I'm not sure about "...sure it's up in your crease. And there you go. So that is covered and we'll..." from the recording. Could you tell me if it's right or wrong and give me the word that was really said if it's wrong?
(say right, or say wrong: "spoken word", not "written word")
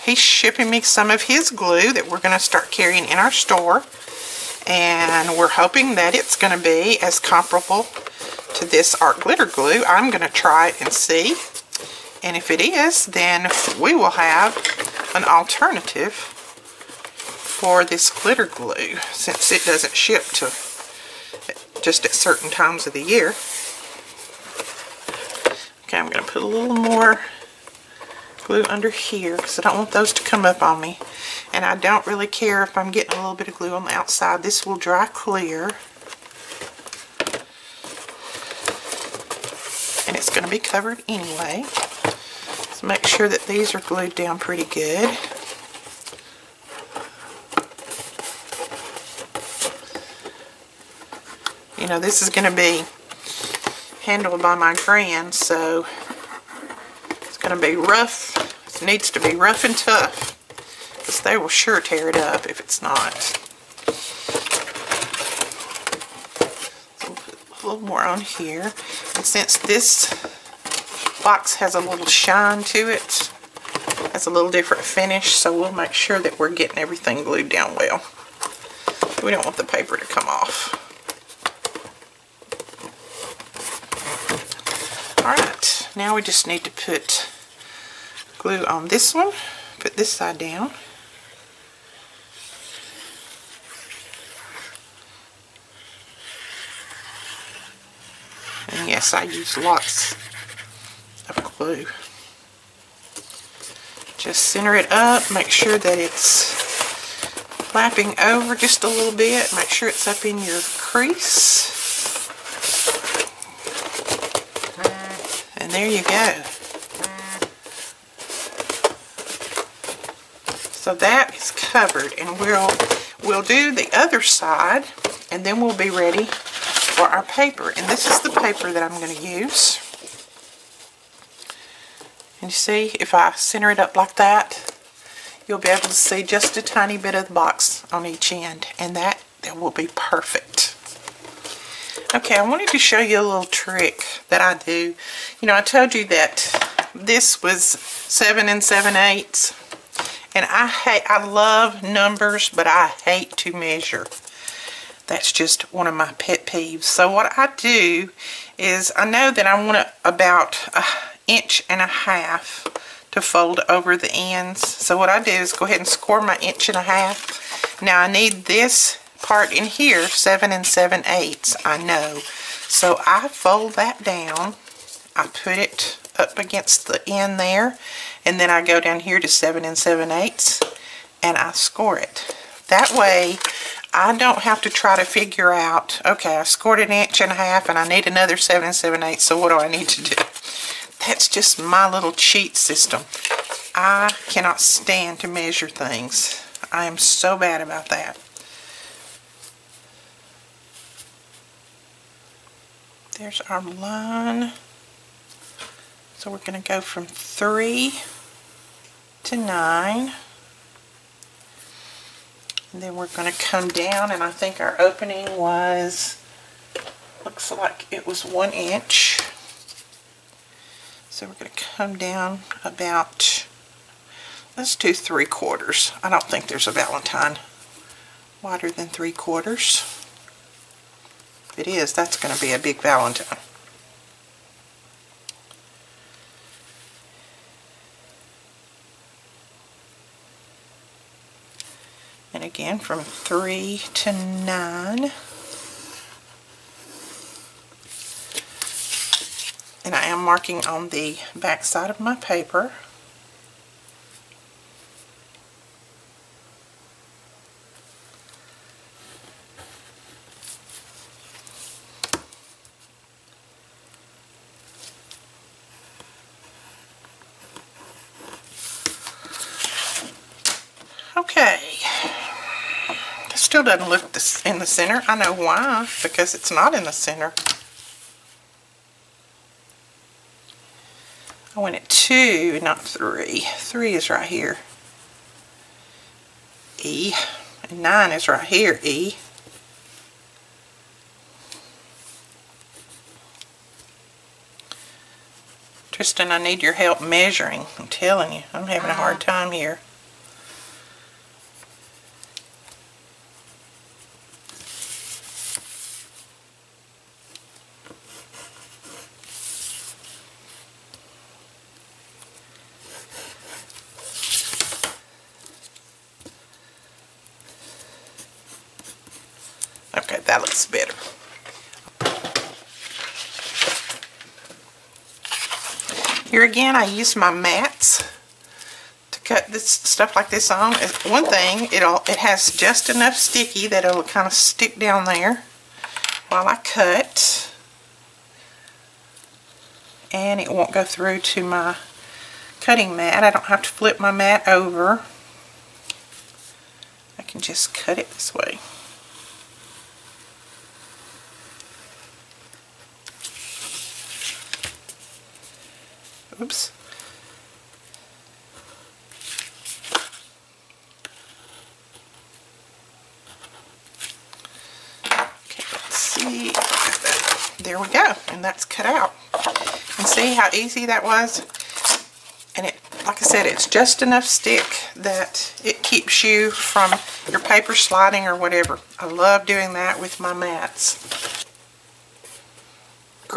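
right.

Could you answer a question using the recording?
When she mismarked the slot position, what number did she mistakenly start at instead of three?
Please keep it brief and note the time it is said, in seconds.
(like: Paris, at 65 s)
2, at 281 s.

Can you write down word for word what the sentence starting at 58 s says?
It needs to be rough and tough, because they will sure tear it up if it's not.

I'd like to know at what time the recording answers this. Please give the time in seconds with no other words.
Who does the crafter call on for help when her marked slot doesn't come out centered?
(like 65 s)
295 s.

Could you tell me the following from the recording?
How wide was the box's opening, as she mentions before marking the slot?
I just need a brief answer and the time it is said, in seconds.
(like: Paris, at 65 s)
1 inch, at 218 s.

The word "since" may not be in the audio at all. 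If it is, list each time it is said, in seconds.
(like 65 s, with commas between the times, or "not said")
19 s, 69 s.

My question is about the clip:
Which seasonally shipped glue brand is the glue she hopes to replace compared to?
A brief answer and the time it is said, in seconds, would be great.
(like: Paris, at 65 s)
Art Glitter glue, at 9 s.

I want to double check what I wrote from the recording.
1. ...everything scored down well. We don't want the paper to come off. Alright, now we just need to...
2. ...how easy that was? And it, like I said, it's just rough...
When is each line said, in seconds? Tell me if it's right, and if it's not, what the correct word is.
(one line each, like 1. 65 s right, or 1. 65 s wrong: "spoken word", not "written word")
1. 76 s wrong: "glued", not "scored"
2. 370 s wrong: "enough", not "rough".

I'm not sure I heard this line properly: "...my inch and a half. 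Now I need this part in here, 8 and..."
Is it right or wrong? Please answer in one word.
wrong.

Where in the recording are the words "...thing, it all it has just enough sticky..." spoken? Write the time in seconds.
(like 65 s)
331 s.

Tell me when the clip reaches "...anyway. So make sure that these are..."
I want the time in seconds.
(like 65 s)
41 s.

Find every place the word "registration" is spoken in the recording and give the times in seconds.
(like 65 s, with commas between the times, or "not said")
not said.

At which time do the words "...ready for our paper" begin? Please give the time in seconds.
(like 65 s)
125 s.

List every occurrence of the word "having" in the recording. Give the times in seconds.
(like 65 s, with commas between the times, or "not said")
298 s.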